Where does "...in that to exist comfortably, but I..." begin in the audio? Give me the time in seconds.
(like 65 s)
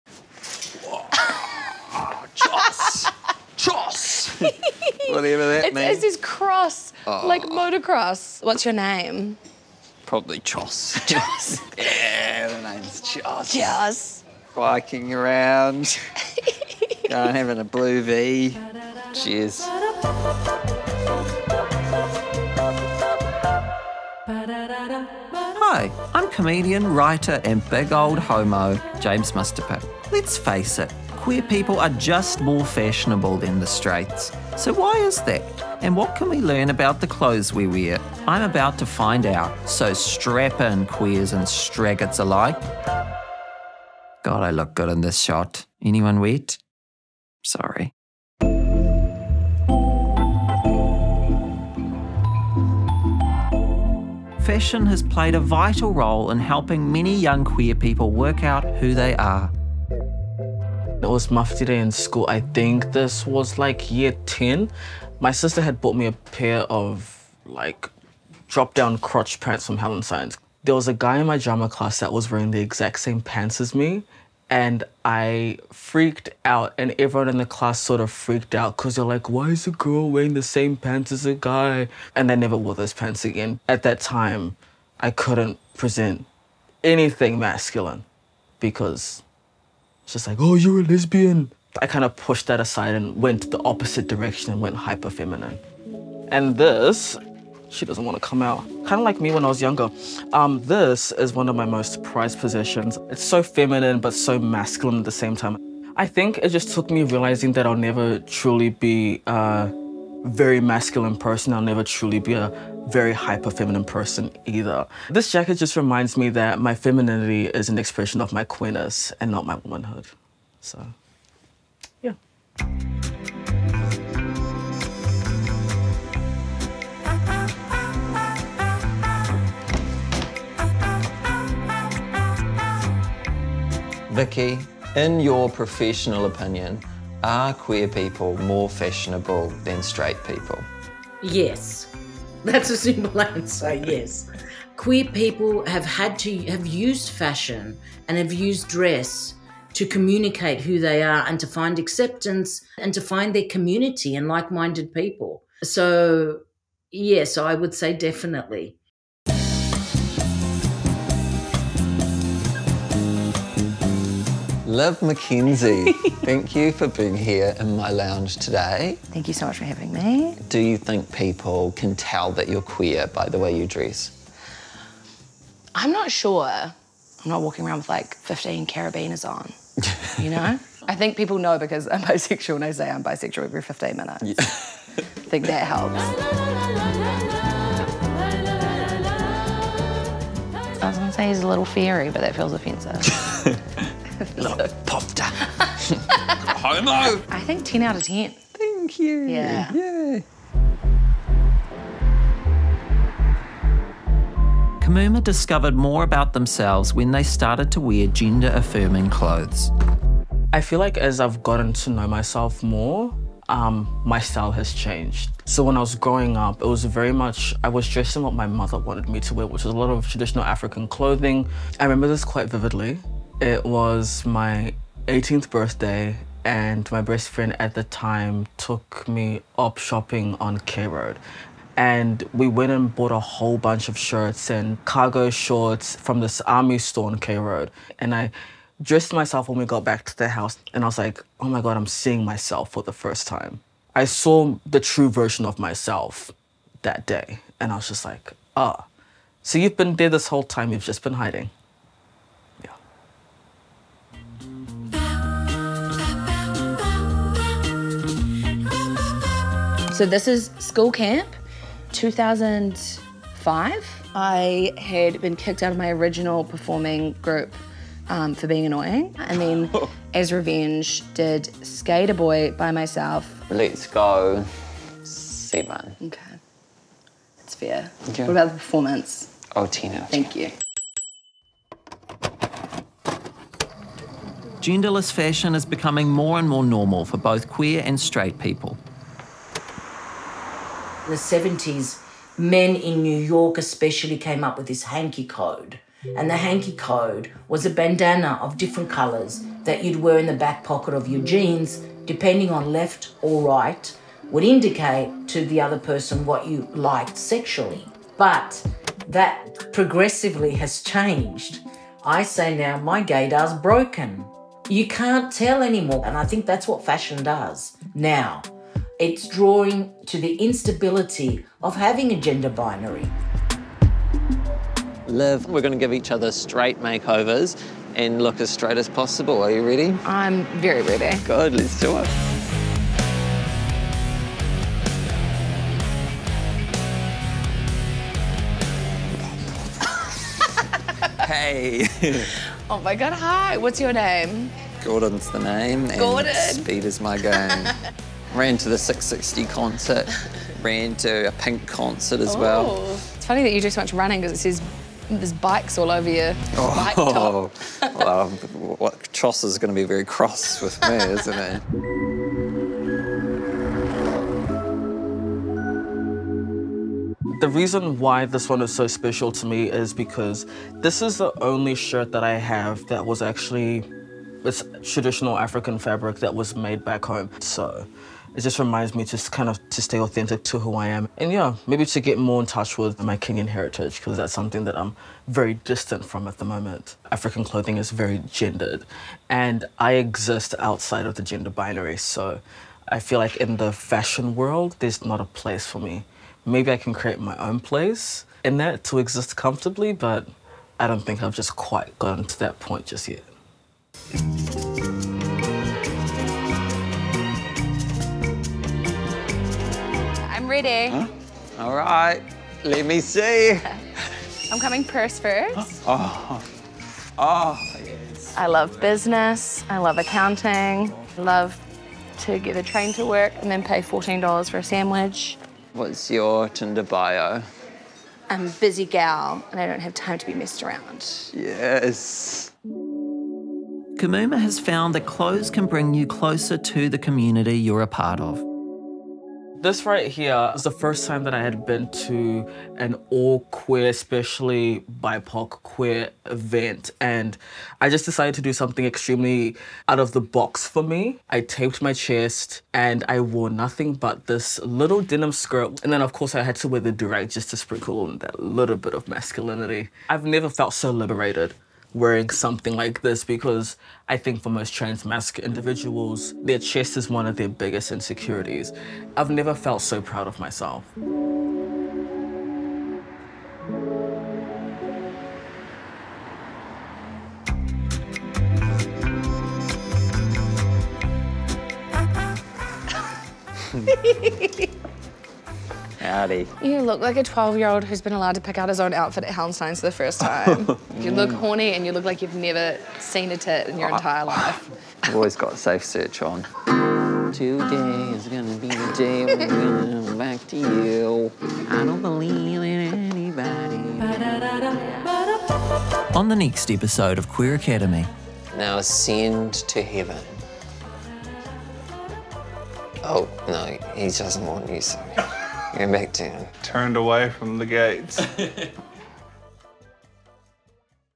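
398 s.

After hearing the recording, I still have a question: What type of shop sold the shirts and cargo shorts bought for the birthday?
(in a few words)
army store.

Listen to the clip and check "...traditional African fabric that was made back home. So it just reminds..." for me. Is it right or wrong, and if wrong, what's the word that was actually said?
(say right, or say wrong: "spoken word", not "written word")
right.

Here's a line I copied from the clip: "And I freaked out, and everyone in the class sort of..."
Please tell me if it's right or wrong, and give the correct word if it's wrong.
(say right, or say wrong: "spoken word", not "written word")
right.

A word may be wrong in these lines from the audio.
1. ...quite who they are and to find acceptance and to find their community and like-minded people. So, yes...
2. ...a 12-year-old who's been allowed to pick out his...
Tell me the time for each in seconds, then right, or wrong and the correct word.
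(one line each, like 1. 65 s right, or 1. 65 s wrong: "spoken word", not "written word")
1. 149 s wrong: "communicate", not "quite"
2. 487 s right.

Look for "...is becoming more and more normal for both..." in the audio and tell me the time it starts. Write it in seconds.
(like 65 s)
285 s.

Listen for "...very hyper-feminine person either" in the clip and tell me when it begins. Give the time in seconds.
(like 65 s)
112 s.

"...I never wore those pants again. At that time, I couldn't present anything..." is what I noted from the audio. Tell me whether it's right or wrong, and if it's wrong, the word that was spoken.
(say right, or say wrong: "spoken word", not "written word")
right.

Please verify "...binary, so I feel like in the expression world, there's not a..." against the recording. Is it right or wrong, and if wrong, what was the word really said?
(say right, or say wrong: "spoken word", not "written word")
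wrong: "fashion", not "expression".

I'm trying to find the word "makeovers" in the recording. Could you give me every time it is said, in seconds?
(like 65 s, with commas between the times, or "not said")
326 s.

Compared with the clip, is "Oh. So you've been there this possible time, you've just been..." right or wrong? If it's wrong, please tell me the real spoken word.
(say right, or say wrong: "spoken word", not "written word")
wrong: "whole", not "possible".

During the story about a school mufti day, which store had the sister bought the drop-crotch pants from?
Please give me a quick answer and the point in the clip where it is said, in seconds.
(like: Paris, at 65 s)
Hallensteins, at 69 s.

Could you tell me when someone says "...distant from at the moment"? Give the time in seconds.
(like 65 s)
385 s.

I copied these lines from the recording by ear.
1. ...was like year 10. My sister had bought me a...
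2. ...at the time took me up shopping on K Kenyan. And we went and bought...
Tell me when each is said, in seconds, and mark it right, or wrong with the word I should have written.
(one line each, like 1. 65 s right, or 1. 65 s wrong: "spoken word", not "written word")
1. 63 s right
2. 227 s wrong: "Road", not "Kenyan".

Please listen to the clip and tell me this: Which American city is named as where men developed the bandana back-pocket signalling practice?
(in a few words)
New York.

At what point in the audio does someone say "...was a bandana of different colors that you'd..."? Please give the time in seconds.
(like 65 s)
297 s.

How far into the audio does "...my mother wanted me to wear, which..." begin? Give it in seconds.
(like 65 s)
218 s.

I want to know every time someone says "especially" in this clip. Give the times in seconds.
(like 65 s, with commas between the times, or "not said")
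293 s, 443 s.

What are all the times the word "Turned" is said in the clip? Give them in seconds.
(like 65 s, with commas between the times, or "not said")
516 s.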